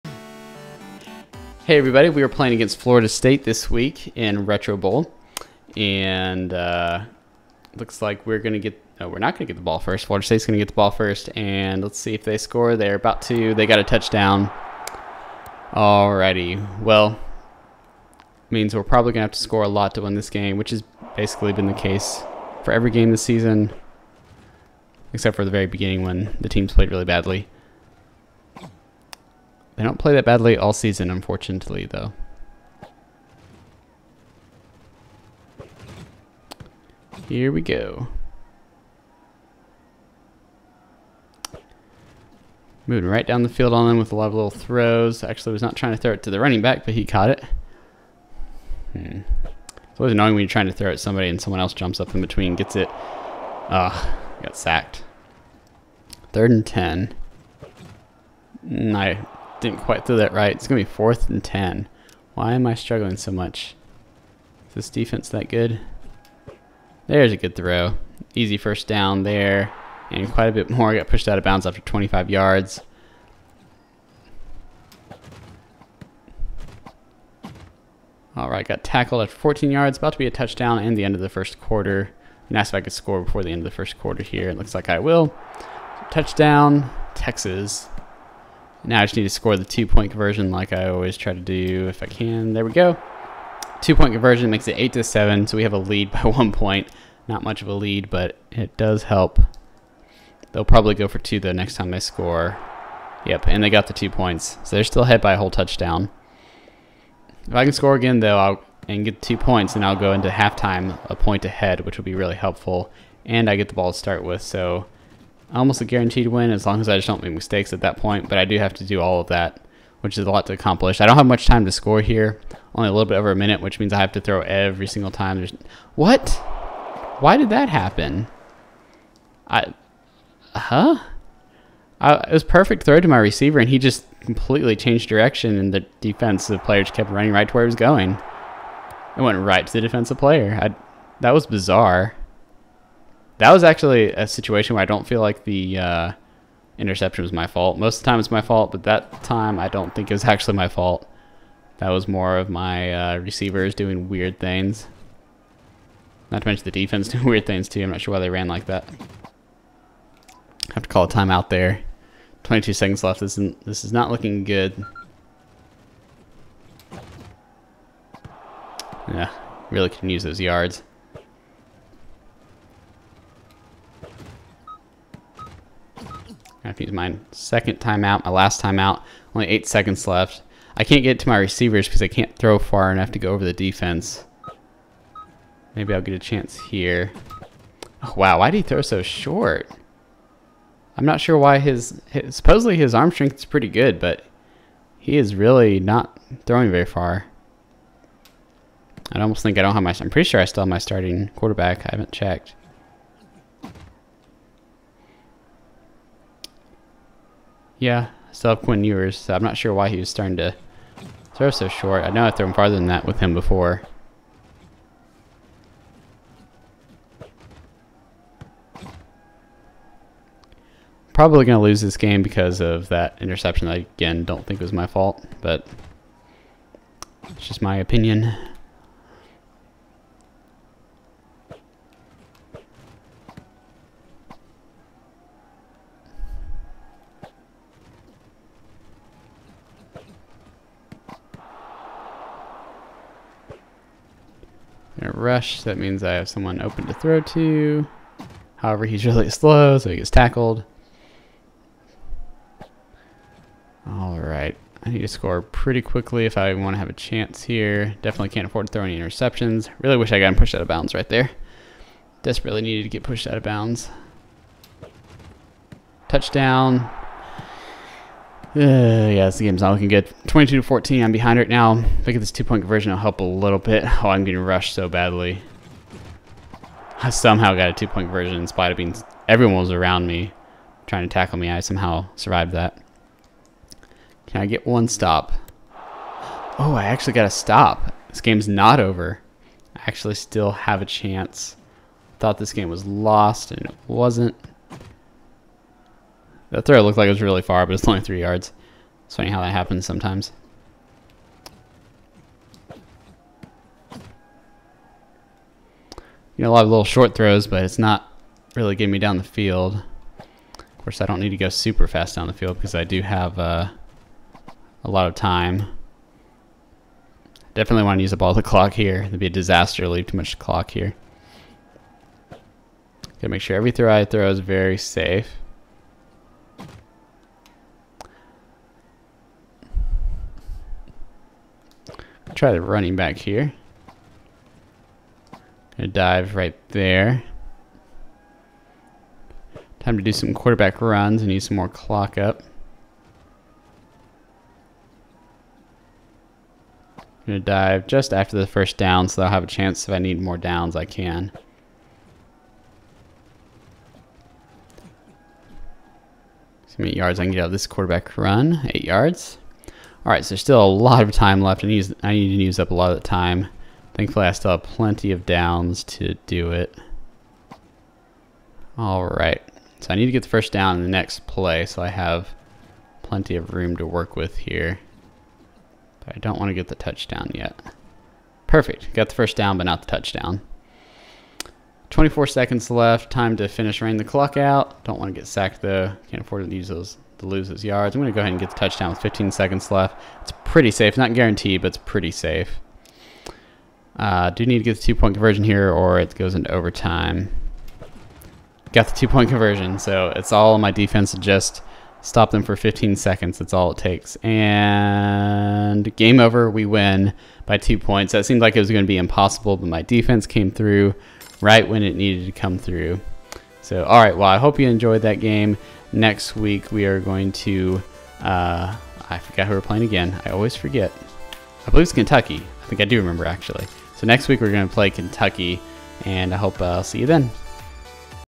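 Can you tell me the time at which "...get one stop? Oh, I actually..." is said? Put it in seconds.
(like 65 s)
284 s.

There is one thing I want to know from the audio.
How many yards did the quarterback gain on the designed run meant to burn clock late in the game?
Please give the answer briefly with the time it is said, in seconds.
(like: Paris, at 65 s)
8, at 358 s.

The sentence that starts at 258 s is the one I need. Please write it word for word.
Definitely can't afford to throw any interceptions.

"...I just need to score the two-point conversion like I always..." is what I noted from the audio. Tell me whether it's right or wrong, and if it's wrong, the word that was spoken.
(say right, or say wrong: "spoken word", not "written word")
right.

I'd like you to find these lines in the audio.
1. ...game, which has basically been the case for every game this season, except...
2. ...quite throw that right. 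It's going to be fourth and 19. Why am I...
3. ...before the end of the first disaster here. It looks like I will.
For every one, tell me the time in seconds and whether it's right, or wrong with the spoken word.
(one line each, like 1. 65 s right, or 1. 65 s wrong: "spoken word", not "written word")
1. 20 s right
2. 59 s wrong: "10", not "19"
3. 83 s wrong: "quarter", not "disaster".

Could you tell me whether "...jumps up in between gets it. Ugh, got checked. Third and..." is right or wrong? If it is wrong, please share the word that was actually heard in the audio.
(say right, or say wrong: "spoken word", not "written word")
wrong: "sacked", not "checked".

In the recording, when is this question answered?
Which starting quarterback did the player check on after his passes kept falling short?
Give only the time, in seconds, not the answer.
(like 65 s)
208 s.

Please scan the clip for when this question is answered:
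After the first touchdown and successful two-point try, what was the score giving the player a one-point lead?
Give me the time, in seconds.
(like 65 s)
94 s.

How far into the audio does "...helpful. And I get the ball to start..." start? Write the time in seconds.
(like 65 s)
112 s.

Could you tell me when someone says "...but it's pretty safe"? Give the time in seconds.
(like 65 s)
391 s.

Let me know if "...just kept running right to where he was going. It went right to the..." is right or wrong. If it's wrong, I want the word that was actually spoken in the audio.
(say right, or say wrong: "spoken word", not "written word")
right.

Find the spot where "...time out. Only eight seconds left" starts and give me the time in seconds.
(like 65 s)
178 s.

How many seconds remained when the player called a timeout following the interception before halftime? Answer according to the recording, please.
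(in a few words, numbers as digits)
22.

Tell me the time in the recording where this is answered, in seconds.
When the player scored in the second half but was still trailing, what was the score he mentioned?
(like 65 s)
270 s.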